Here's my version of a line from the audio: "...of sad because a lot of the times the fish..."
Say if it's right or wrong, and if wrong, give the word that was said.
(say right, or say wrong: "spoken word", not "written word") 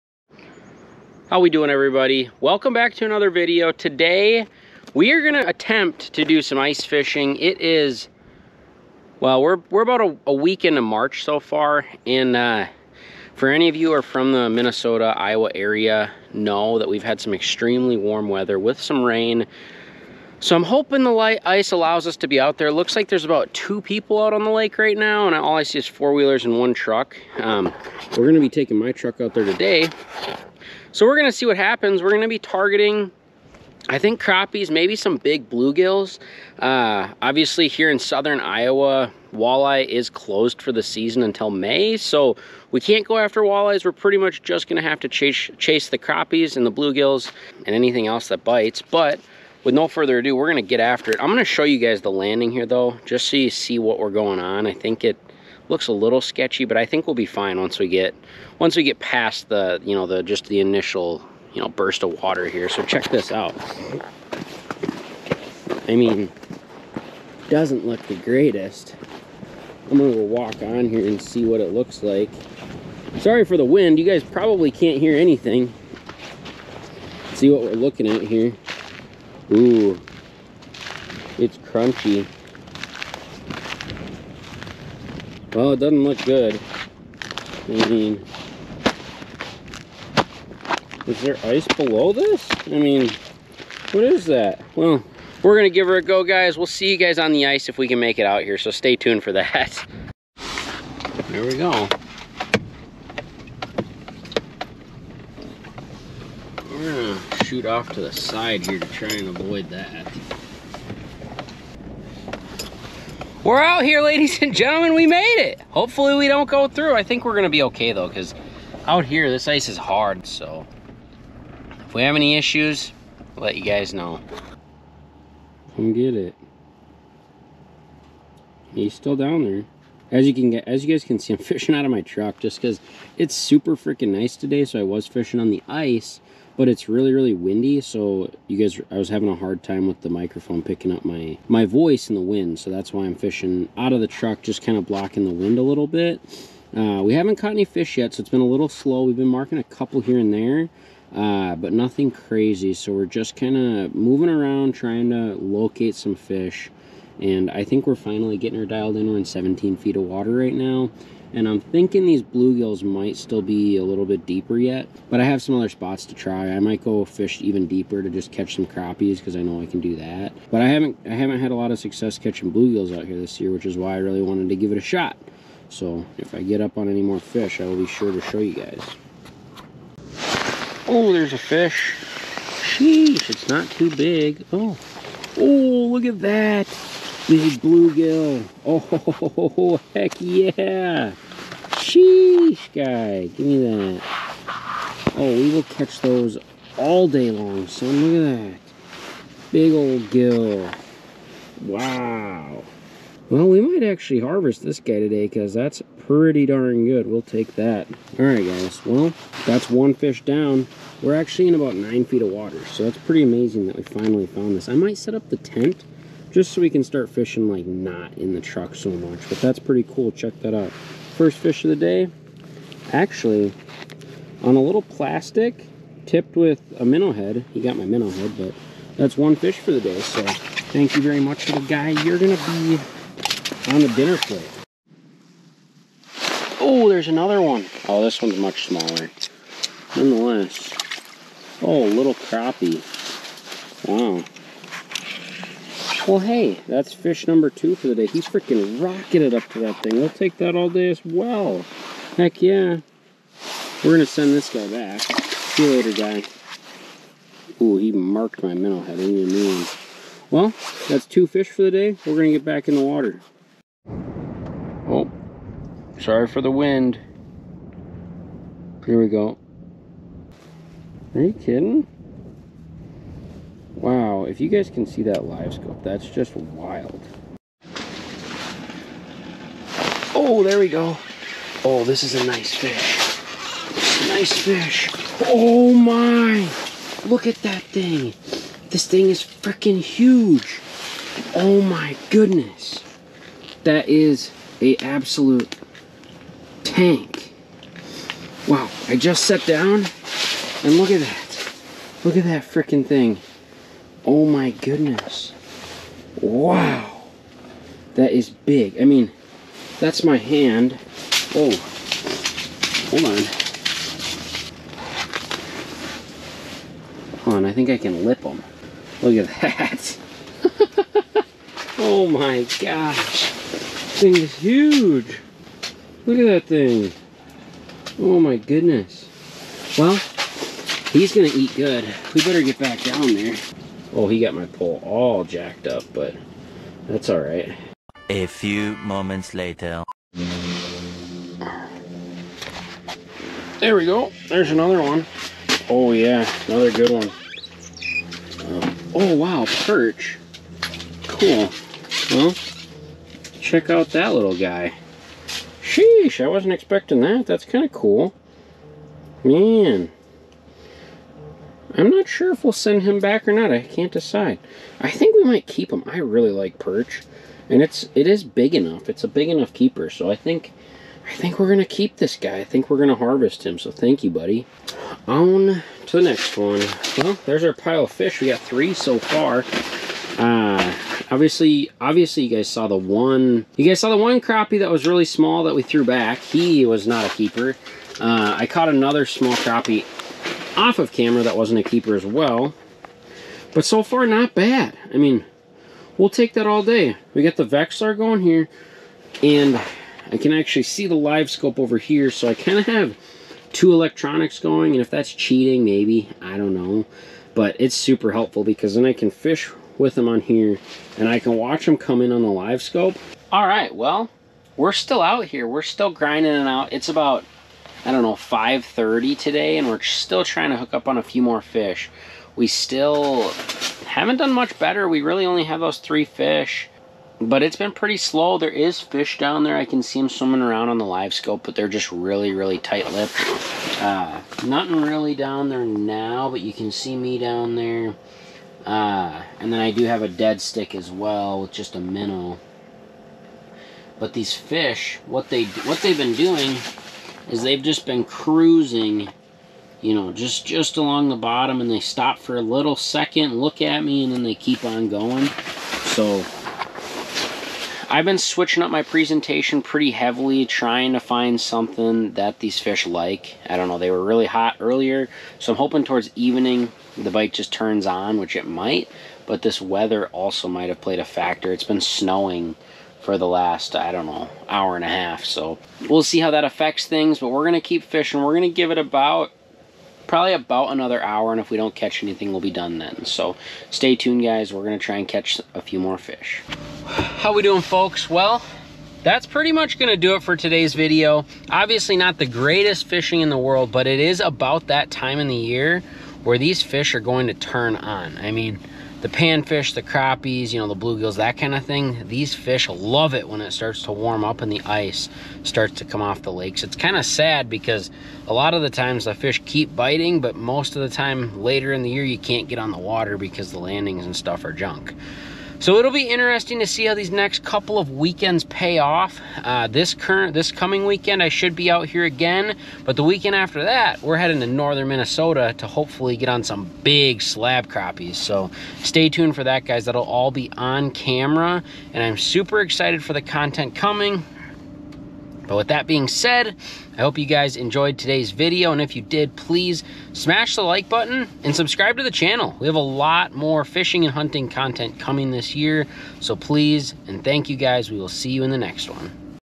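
right.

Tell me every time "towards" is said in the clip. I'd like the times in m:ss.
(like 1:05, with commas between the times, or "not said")
7:45.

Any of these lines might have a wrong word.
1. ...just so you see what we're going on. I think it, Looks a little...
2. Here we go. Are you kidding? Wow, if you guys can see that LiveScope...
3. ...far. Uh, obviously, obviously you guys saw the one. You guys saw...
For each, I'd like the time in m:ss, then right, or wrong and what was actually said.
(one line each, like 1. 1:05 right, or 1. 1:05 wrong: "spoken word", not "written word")
1. 0:53 right
2. 4:28 right
3. 6:18 right.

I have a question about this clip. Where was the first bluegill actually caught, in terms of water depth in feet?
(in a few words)
9.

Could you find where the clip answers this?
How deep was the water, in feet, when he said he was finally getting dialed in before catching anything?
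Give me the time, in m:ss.
2:39.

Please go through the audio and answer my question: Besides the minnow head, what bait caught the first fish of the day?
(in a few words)
A little plastic.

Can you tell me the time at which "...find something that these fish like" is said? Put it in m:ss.
7:41.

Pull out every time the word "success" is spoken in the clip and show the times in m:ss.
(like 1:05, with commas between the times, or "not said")
2:51.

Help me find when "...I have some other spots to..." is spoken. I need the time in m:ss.
2:45.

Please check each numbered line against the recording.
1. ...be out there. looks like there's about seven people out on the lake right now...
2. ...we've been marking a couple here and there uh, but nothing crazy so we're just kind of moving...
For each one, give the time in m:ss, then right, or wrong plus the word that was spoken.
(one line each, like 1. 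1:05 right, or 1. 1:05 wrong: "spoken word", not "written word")
1. 0:22 wrong: "two", not "seven"
2. 2:29 right.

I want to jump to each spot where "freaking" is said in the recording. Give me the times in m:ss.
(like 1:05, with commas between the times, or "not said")
2:13, 4:08, 4:49, 5:02.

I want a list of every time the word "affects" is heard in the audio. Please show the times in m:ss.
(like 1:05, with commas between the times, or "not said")
7:56.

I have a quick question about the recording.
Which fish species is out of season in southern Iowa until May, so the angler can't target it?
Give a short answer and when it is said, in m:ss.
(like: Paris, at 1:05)
Walleye, at 0:39.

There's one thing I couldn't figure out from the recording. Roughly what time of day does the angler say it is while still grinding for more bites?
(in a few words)
5:30.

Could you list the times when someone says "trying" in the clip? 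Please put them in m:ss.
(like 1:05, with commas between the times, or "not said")
2:34, 7:00, 7:40.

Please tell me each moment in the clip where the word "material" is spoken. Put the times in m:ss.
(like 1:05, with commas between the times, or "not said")
not said.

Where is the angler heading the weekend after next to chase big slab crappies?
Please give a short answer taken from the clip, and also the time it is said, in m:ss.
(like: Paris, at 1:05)
Northern Minnesota, at 8:44.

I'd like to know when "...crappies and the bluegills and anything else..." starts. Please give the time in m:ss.
0:45.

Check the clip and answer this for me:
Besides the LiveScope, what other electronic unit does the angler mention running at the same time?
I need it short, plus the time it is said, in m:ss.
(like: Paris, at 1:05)
Vexilar, at 6:37.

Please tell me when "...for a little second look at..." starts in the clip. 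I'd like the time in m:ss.
7:32.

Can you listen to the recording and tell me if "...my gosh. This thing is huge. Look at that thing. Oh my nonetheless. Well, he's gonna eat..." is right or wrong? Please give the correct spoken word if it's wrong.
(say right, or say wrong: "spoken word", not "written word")
wrong: "goodness", not "nonetheless".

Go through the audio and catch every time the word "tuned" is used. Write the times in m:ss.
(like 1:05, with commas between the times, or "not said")
1:38, 8:03, 8:49.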